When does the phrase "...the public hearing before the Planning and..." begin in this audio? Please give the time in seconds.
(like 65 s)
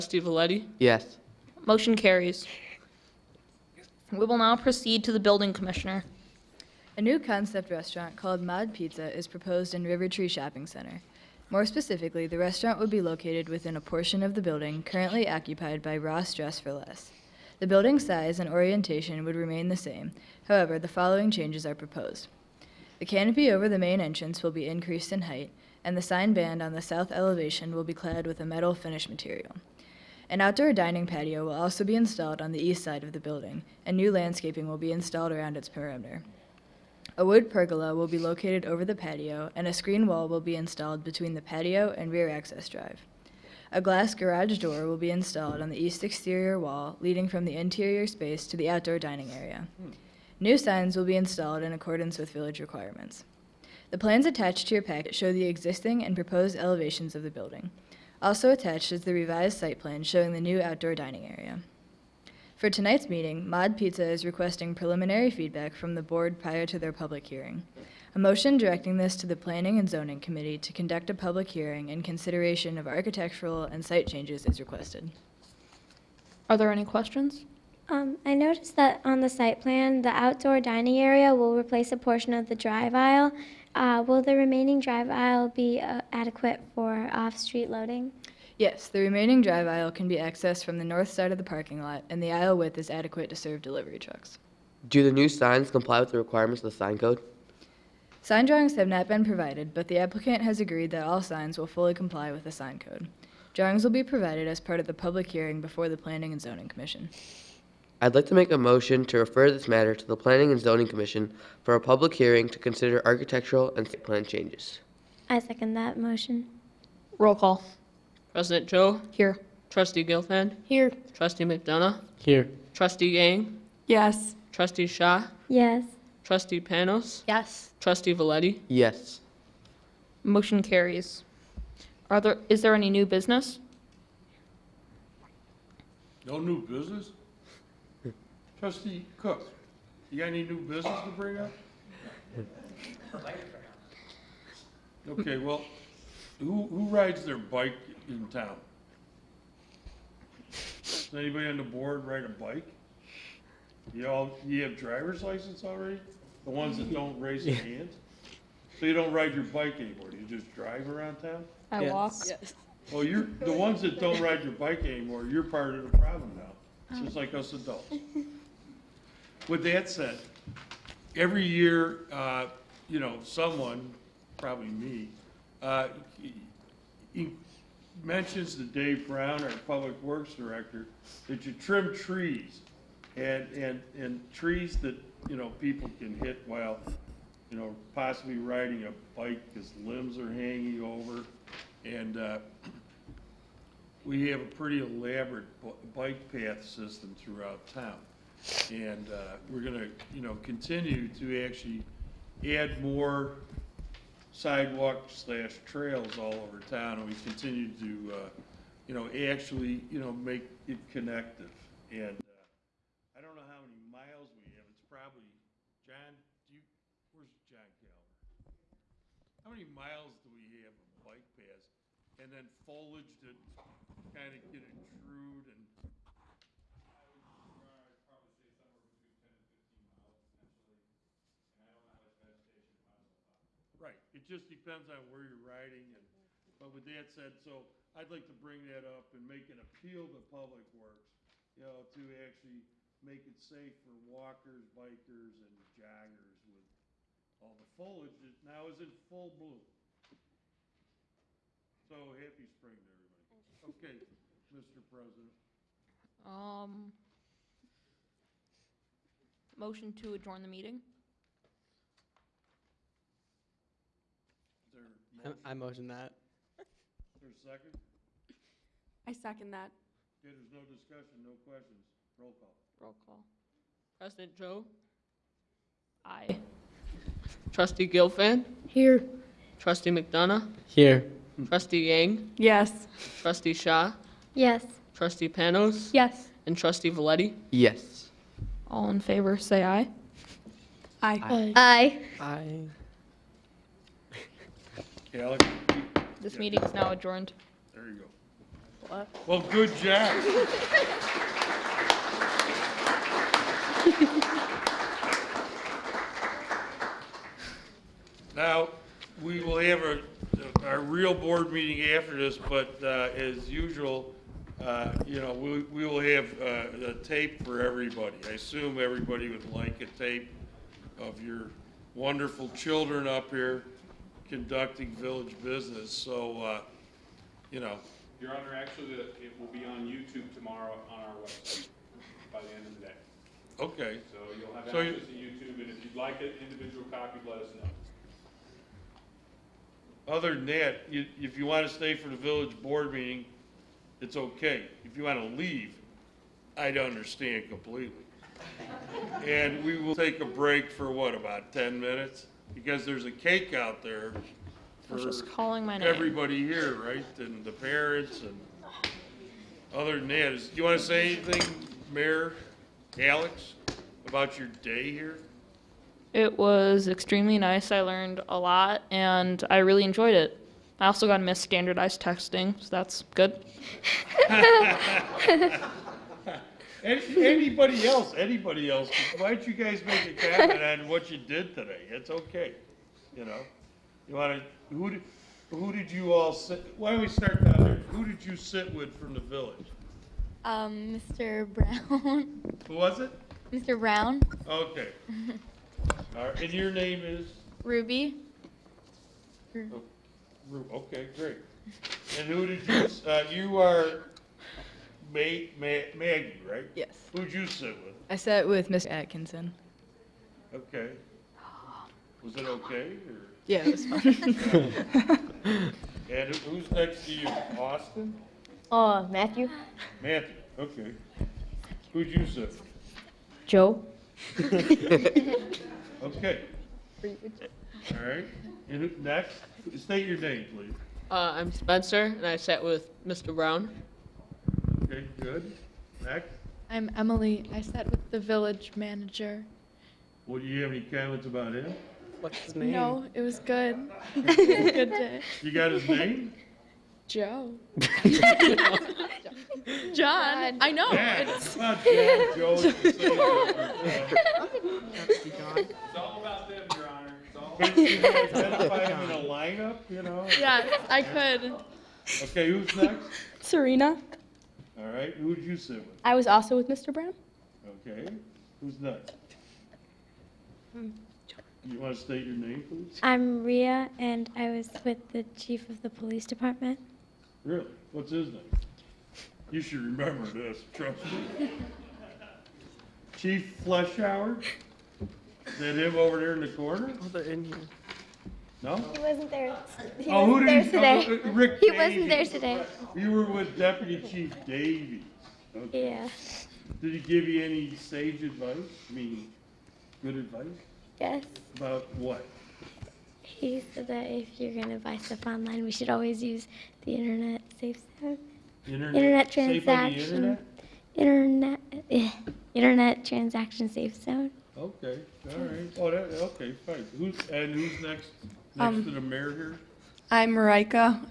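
104 s.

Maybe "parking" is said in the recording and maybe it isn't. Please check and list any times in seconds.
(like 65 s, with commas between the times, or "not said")
91 s.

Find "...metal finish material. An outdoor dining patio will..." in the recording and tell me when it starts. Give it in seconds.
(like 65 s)
28 s.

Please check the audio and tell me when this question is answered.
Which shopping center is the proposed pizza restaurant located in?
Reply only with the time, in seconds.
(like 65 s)
9 s.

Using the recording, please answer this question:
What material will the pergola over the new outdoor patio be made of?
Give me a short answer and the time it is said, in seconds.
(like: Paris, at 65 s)
Wood, at 37 s.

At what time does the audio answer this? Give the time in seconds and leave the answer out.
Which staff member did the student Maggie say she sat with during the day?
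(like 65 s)
408 s.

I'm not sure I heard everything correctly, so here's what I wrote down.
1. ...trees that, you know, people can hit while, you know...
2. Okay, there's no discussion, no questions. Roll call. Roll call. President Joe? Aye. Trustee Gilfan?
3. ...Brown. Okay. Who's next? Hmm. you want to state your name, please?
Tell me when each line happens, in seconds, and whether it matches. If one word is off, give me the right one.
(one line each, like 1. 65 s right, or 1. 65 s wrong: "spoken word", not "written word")
1. 184 s right
2. 270 s right
3. 466 s right.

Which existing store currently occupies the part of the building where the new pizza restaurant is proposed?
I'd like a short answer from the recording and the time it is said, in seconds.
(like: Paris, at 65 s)
Ross Dress for Less, at 15 s.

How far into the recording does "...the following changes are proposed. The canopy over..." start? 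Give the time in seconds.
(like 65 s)
20 s.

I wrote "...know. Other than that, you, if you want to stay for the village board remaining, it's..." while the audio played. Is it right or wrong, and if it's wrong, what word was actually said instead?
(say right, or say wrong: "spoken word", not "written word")
wrong: "meeting", not "remaining".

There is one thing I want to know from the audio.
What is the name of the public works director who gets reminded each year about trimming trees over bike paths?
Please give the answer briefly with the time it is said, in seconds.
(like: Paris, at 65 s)
Dave Brown, at 178 s.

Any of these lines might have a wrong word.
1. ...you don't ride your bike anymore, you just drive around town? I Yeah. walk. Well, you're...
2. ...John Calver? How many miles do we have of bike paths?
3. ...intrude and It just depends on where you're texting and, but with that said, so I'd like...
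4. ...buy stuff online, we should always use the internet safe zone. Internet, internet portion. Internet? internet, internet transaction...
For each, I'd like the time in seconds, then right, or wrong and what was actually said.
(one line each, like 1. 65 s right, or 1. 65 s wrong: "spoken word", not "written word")
1. 158 s right
2. 217 s right
3. 224 s wrong: "riding", not "texting"
4. 504 s wrong: "transaction", not "portion".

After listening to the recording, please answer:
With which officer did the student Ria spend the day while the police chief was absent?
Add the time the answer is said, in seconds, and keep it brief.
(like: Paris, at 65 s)
Deputy Chief Davies, at 493 s.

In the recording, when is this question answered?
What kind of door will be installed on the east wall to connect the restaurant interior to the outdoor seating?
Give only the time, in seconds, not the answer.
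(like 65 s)
43 s.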